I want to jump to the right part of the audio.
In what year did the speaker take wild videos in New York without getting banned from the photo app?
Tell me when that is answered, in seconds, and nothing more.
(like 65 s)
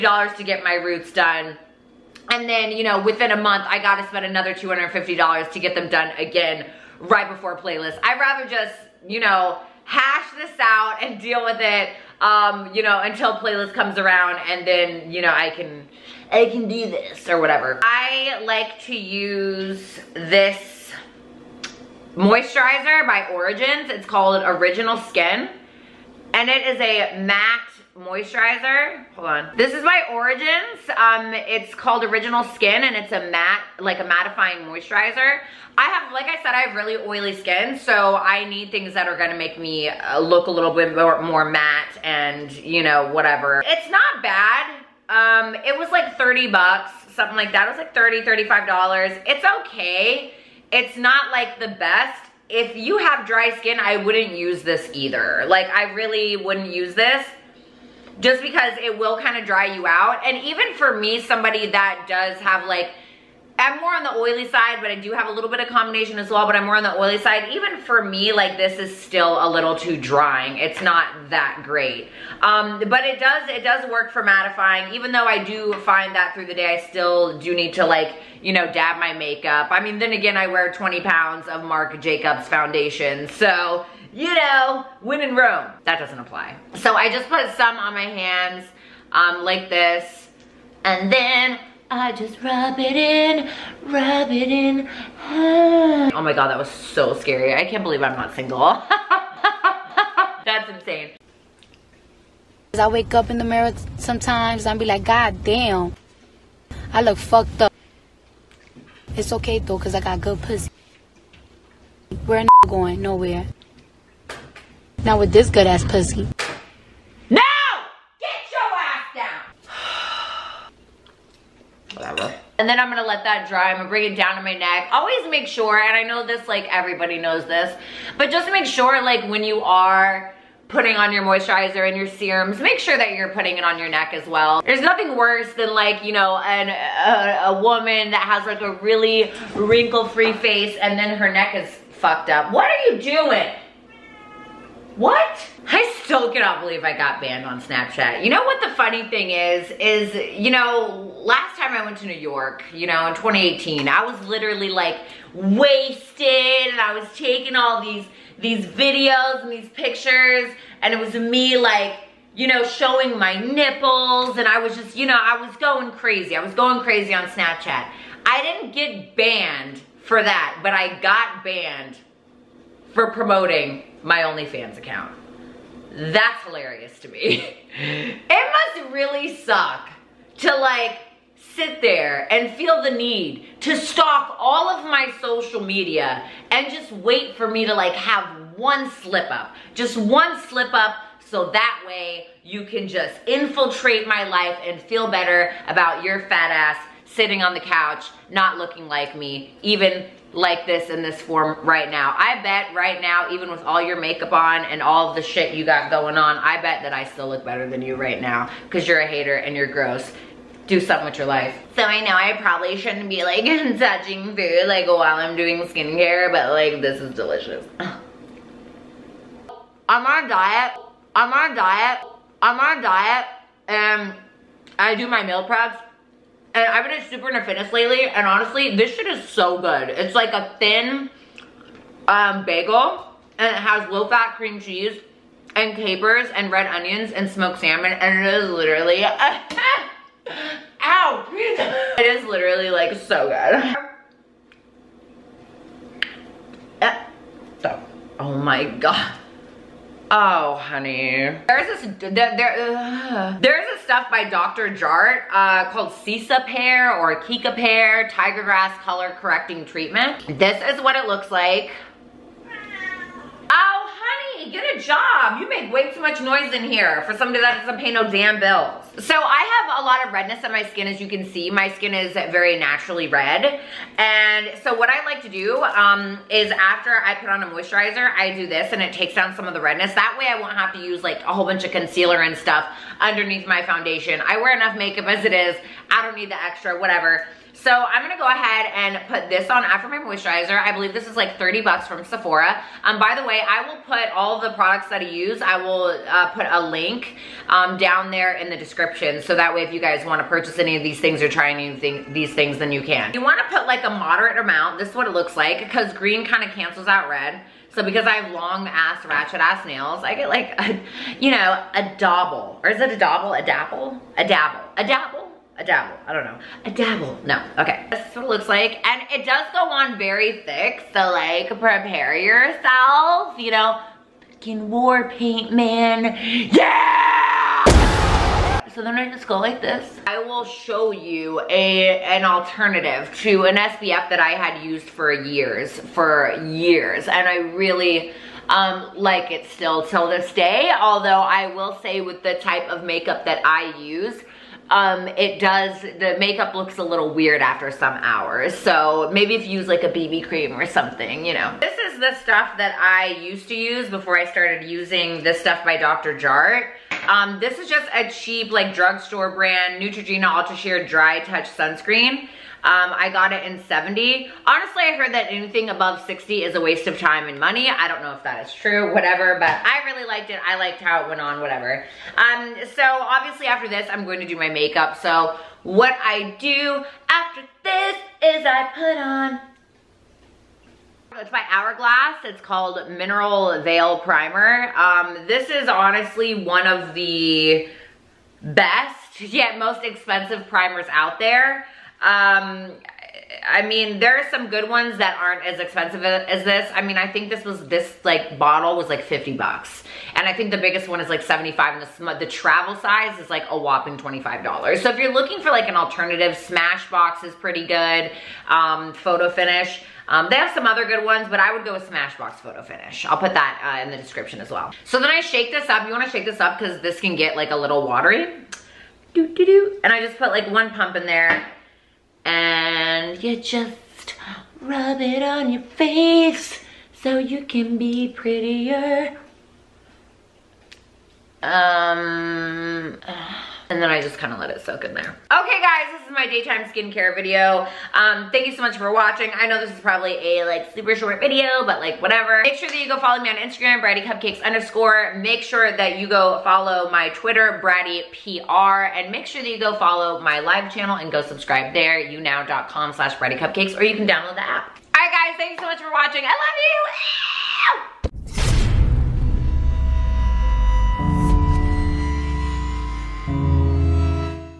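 153 s.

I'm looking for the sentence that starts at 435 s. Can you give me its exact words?
Okay guys, this is my daytime skincare video.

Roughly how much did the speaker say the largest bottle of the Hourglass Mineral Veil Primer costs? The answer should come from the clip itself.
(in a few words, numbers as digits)
$75.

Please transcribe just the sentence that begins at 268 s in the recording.
So I have a lot of redness on my skin.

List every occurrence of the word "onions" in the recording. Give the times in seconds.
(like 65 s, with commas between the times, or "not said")
236 s.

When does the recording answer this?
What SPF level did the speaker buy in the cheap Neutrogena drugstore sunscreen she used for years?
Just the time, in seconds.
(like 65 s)
363 s.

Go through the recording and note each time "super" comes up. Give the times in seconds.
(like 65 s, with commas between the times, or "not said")
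227 s, 440 s.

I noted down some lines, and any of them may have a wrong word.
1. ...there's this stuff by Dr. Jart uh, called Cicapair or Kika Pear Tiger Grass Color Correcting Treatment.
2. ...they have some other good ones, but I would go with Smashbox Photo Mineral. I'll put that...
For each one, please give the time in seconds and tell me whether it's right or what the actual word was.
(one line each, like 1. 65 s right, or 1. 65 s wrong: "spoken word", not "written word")
1. 253 s right
2. 410 s wrong: "Finish", not "Mineral".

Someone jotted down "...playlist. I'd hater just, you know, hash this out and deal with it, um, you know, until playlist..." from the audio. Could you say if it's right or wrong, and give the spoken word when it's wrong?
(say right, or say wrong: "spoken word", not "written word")
wrong: "rather", not "hater".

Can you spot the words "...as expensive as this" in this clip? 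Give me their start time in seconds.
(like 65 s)
395 s.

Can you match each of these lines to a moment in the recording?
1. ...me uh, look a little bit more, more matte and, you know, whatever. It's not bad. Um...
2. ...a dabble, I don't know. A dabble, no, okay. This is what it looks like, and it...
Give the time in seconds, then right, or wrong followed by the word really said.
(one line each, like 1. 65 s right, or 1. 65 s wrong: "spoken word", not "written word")
1. 39 s right
2. 315 s right.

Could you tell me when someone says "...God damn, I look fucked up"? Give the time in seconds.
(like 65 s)
105 s.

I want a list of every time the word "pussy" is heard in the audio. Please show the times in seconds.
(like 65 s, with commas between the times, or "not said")
110 s, 115 s.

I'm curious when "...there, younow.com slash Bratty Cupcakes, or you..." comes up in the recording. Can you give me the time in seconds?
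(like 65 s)
451 s.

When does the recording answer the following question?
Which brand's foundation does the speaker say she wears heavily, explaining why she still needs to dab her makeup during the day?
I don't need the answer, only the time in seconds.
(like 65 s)
81 s.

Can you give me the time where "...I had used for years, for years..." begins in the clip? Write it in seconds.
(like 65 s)
334 s.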